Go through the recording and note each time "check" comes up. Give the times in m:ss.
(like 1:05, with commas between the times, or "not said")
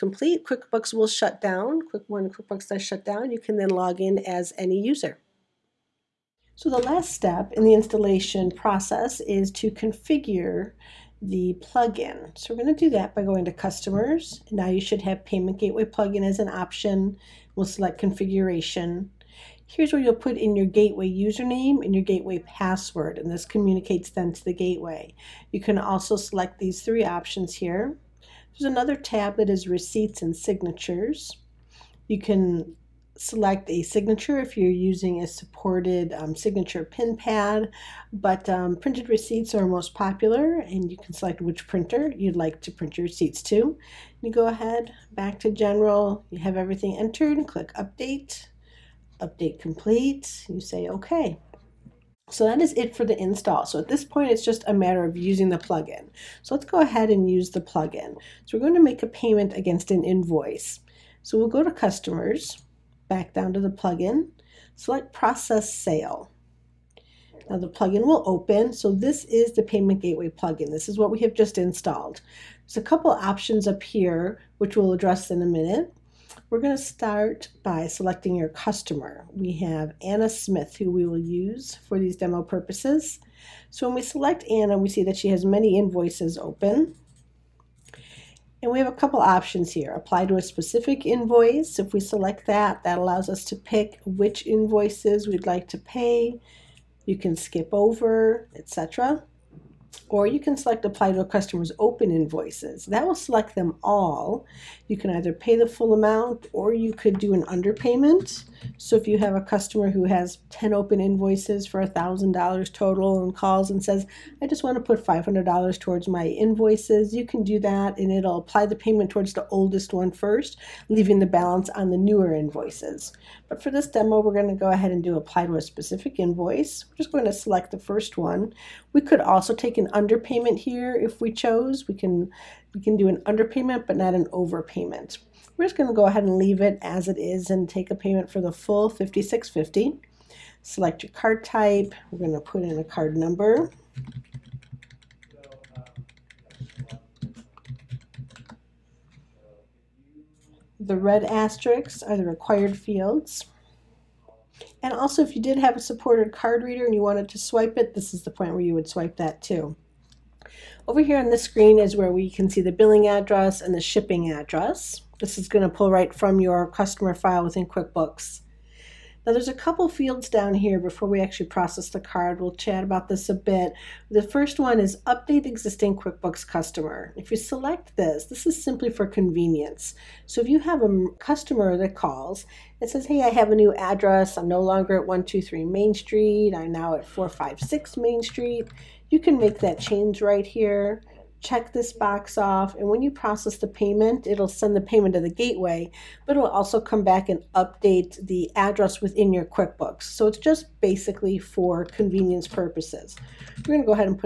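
3:11.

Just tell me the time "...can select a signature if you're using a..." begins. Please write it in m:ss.
0:32.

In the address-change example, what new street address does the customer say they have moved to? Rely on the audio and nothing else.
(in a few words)
456 Main Street.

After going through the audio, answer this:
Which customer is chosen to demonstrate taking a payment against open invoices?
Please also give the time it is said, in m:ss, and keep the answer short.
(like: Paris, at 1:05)
Anna Smith, at 1:20.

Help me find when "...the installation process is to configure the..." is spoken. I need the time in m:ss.
0:07.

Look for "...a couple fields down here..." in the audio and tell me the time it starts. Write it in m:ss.
2:49.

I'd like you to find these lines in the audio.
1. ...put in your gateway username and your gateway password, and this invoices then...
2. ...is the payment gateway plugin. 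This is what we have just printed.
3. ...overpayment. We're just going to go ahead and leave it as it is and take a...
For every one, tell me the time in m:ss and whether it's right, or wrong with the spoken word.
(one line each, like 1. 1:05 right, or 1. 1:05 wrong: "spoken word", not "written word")
1. 0:20 wrong: "communicates", not "invoices"
2. 1:09 wrong: "installed", not "printed"
3. 2:14 right.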